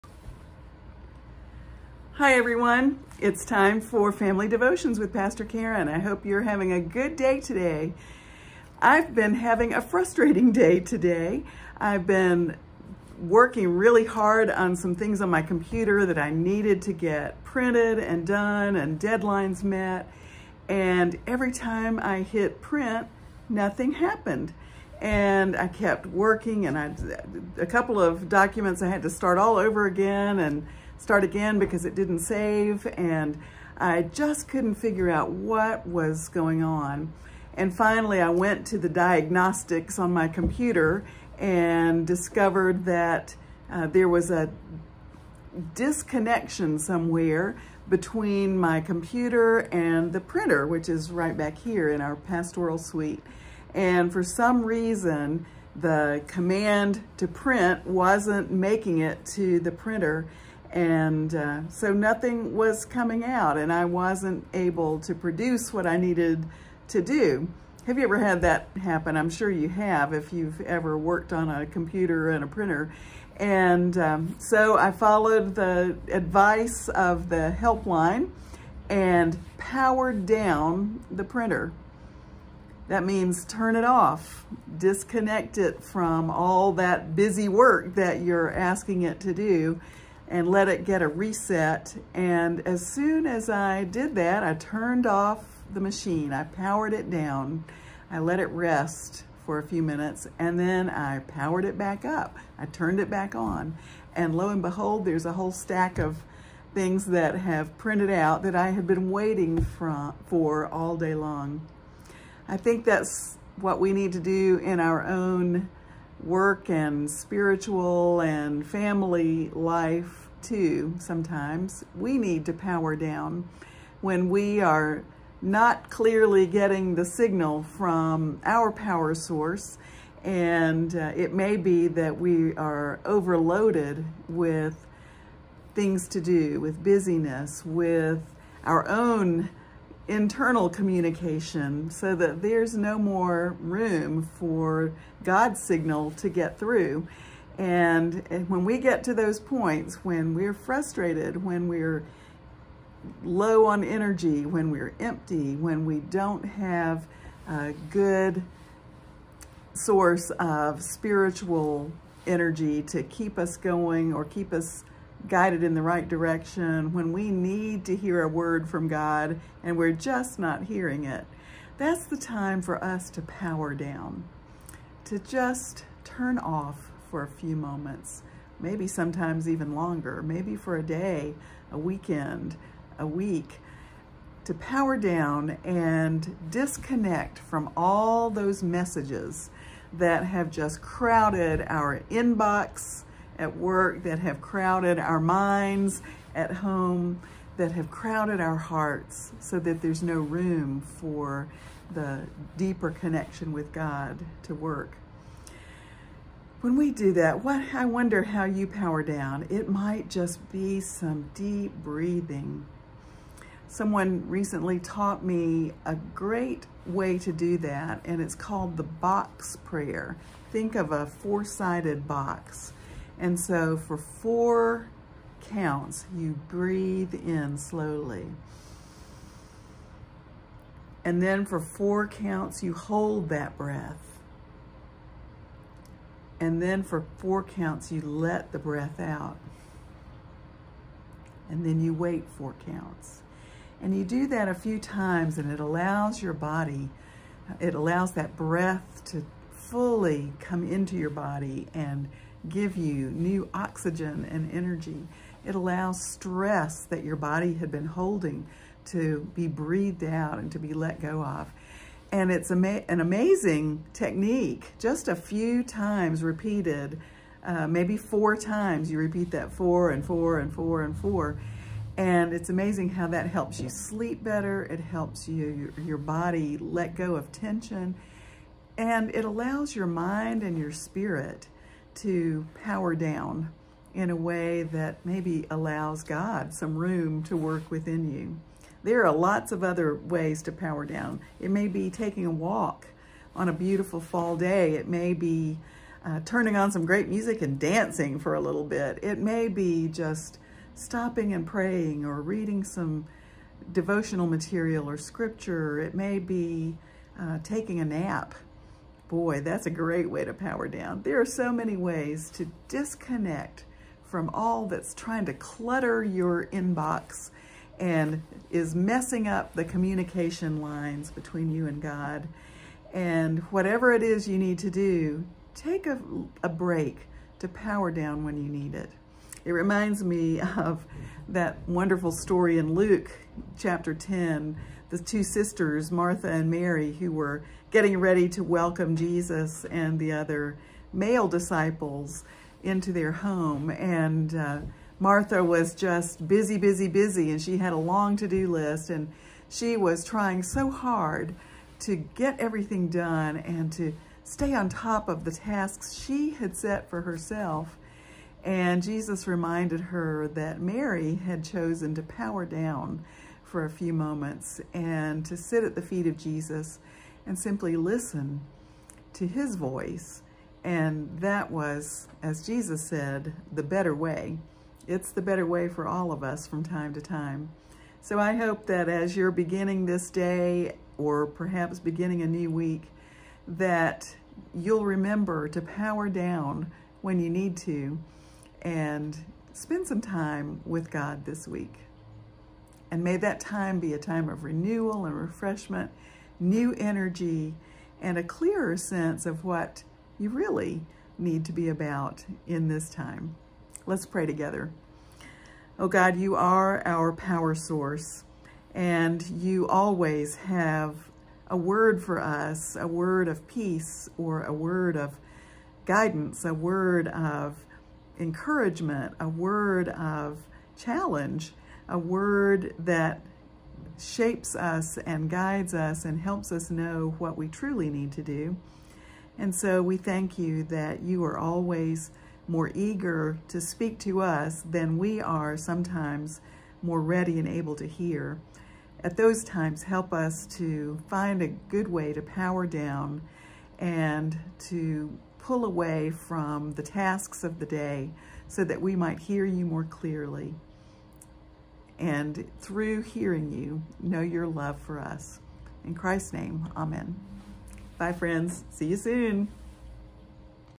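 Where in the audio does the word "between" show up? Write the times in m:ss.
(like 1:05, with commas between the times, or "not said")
0:47, 5:21.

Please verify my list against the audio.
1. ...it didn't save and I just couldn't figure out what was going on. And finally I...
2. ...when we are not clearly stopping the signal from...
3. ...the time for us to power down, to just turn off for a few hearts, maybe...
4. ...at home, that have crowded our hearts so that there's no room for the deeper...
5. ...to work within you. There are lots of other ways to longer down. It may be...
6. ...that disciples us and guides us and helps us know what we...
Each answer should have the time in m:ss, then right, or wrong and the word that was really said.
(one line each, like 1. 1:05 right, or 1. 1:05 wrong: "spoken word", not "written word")
1. 0:31 right
2. 2:04 wrong: "getting", not "stopping"
3. 2:52 wrong: "moments", not "hearts"
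4. 3:16 right
5. 4:47 wrong: "power", not "longer"
6. 7:02 wrong: "shapes", not "disciples".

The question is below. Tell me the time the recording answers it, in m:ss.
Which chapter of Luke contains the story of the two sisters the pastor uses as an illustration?
5:33.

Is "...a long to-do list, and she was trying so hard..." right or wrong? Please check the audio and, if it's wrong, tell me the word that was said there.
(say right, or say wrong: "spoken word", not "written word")
right.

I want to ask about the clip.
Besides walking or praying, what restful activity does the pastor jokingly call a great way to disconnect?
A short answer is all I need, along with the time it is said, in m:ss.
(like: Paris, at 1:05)
Taking a nap, at 5:07.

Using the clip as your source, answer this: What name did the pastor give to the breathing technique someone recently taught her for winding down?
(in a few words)
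Box prayer.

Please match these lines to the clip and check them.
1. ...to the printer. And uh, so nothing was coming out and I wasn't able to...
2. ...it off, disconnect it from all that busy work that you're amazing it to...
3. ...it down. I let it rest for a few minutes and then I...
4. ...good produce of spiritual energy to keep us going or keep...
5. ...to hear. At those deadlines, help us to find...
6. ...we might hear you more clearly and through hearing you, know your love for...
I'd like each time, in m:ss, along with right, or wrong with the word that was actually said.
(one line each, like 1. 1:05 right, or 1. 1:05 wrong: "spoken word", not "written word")
1. 0:59 right
2. 1:23 wrong: "asking", not "amazing"
3. 1:36 right
4. 2:37 wrong: "source", not "produce"
5. 7:17 wrong: "times", not "deadlines"
6. 7:28 right.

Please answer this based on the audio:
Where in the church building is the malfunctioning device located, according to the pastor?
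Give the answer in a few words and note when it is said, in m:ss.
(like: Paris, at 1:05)
Pastoral suite, at 0:52.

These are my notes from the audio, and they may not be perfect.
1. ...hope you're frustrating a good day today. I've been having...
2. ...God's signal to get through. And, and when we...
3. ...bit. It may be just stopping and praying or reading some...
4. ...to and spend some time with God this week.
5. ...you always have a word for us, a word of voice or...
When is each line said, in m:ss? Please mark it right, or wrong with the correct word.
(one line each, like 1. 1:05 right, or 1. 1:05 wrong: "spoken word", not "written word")
1. 0:05 wrong: "having", not "frustrating"
2. 2:25 right
3. 4:58 right
4. 6:27 right
5. 6:49 wrong: "peace", not "voice".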